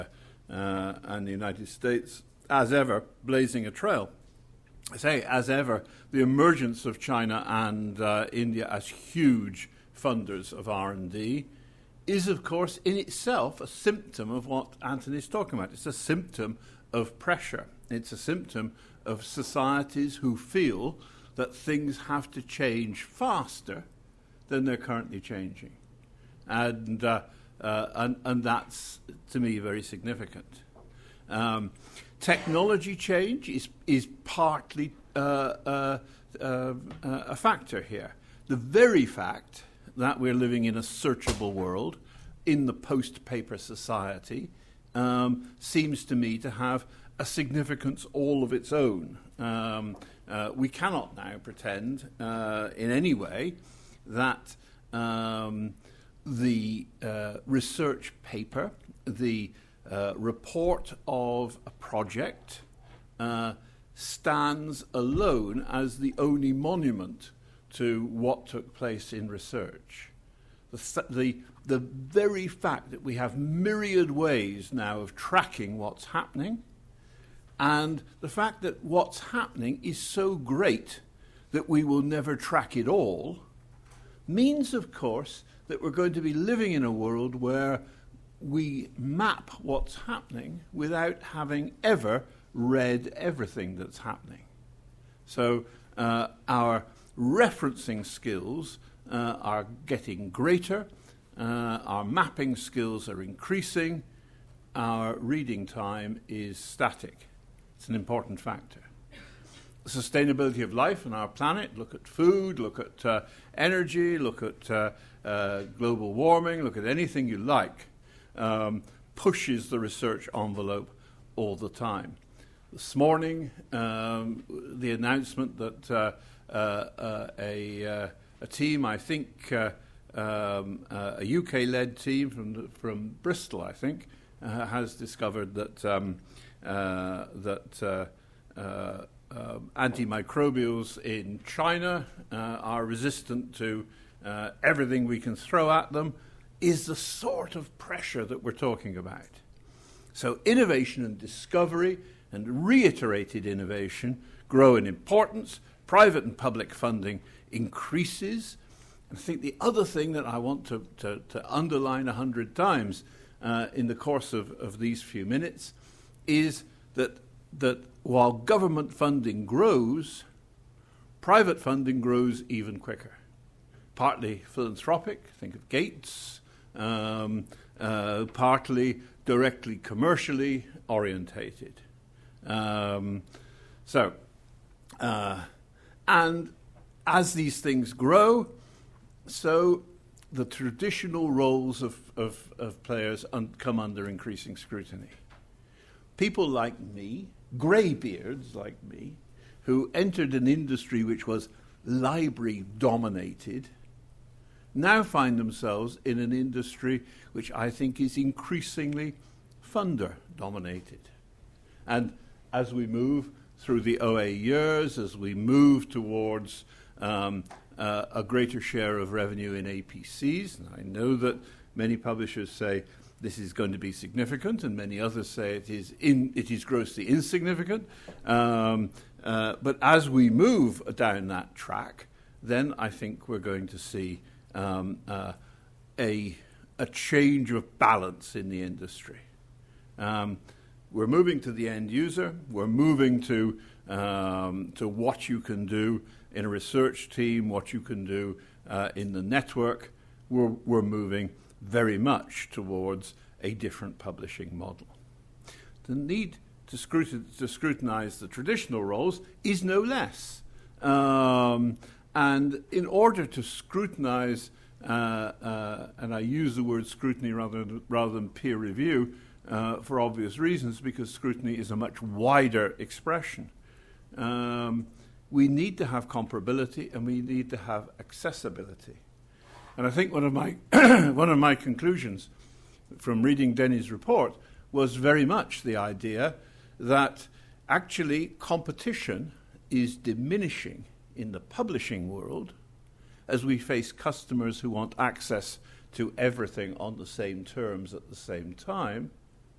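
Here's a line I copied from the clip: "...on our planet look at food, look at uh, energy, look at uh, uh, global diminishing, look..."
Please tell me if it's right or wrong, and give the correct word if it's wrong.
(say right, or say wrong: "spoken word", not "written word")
wrong: "warming", not "diminishing".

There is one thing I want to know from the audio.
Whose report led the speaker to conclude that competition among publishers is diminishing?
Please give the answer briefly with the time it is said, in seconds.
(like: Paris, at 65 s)
Denny's, at 283 s.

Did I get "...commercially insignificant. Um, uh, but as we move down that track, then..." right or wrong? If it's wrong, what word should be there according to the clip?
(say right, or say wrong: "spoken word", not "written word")
wrong: "grossly", not "commercially".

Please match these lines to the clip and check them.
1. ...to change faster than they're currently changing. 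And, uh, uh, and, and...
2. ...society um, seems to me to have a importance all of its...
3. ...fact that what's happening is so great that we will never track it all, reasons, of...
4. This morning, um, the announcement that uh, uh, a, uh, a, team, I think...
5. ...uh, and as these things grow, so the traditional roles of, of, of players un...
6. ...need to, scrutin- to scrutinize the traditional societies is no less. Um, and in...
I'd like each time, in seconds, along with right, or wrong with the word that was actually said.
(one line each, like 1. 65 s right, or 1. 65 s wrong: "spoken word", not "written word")
1. 22 s right
2. 43 s wrong: "significance", not "importance"
3. 78 s wrong: "means", not "reasons"
4. 122 s right
5. 184 s right
6. 255 s wrong: "roles", not "societies".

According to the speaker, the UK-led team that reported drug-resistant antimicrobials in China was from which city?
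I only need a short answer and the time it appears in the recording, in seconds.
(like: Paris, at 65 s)
Bristol, at 133 s.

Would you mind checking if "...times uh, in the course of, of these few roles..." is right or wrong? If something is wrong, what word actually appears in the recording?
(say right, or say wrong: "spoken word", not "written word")
wrong: "minutes", not "roles".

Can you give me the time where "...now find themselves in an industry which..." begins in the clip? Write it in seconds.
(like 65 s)
204 s.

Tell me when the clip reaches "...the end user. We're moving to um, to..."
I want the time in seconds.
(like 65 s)
241 s.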